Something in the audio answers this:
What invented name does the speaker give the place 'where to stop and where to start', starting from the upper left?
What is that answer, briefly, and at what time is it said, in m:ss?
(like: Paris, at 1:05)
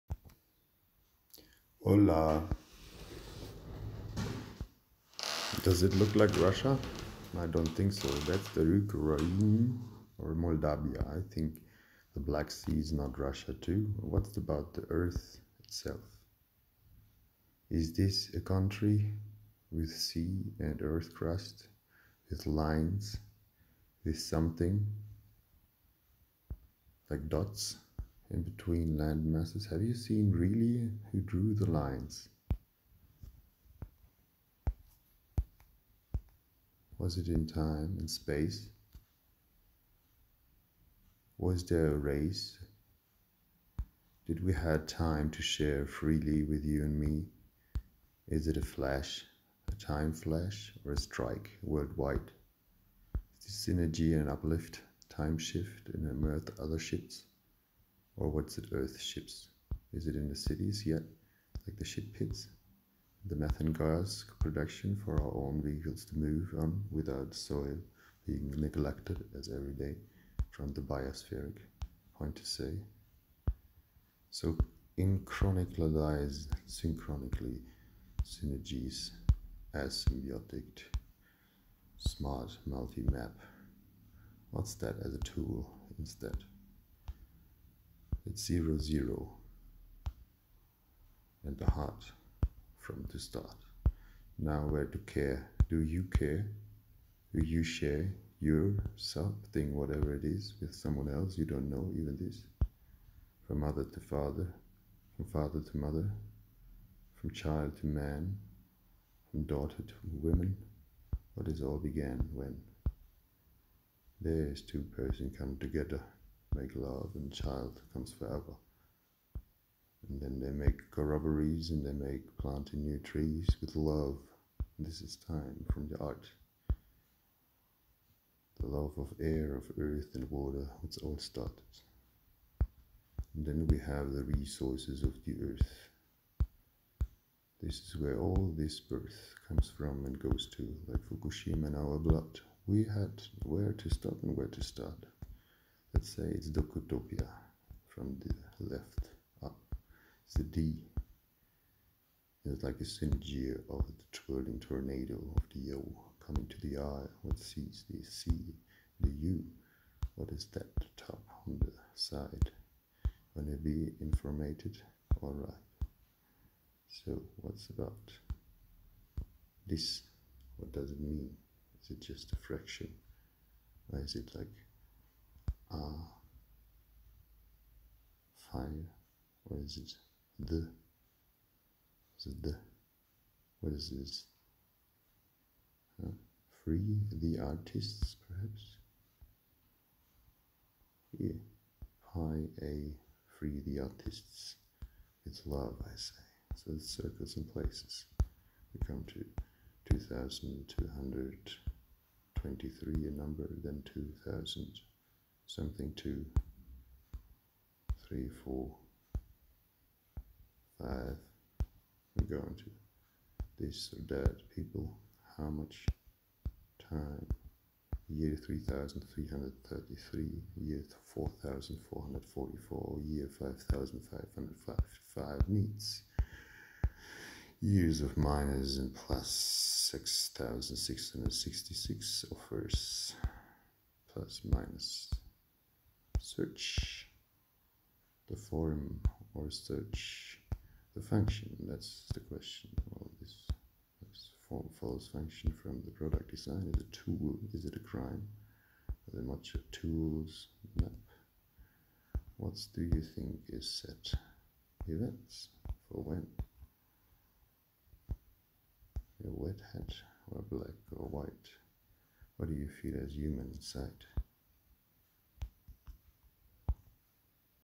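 Docutopia, at 2:26.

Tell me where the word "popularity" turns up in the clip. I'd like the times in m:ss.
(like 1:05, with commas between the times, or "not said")
not said.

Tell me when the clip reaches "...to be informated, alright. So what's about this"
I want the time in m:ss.
2:43.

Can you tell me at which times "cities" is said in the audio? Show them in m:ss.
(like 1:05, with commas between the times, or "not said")
1:00.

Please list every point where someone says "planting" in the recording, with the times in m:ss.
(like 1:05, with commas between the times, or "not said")
2:02.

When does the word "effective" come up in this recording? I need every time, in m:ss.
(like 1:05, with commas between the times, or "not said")
not said.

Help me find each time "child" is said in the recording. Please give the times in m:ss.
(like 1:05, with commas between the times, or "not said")
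1:47, 1:57.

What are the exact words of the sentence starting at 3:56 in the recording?
search the form or search the function?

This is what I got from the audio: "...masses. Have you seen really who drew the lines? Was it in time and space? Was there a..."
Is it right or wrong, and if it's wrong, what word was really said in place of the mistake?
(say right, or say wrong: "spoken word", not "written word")
right.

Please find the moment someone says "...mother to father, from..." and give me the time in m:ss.
1:43.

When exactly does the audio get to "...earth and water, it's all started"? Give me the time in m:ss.
2:09.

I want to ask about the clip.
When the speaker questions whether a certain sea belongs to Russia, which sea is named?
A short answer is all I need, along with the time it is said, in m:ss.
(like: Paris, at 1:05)
Black Sea, at 0:12.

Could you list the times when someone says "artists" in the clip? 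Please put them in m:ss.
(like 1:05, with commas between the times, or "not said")
3:07, 3:13.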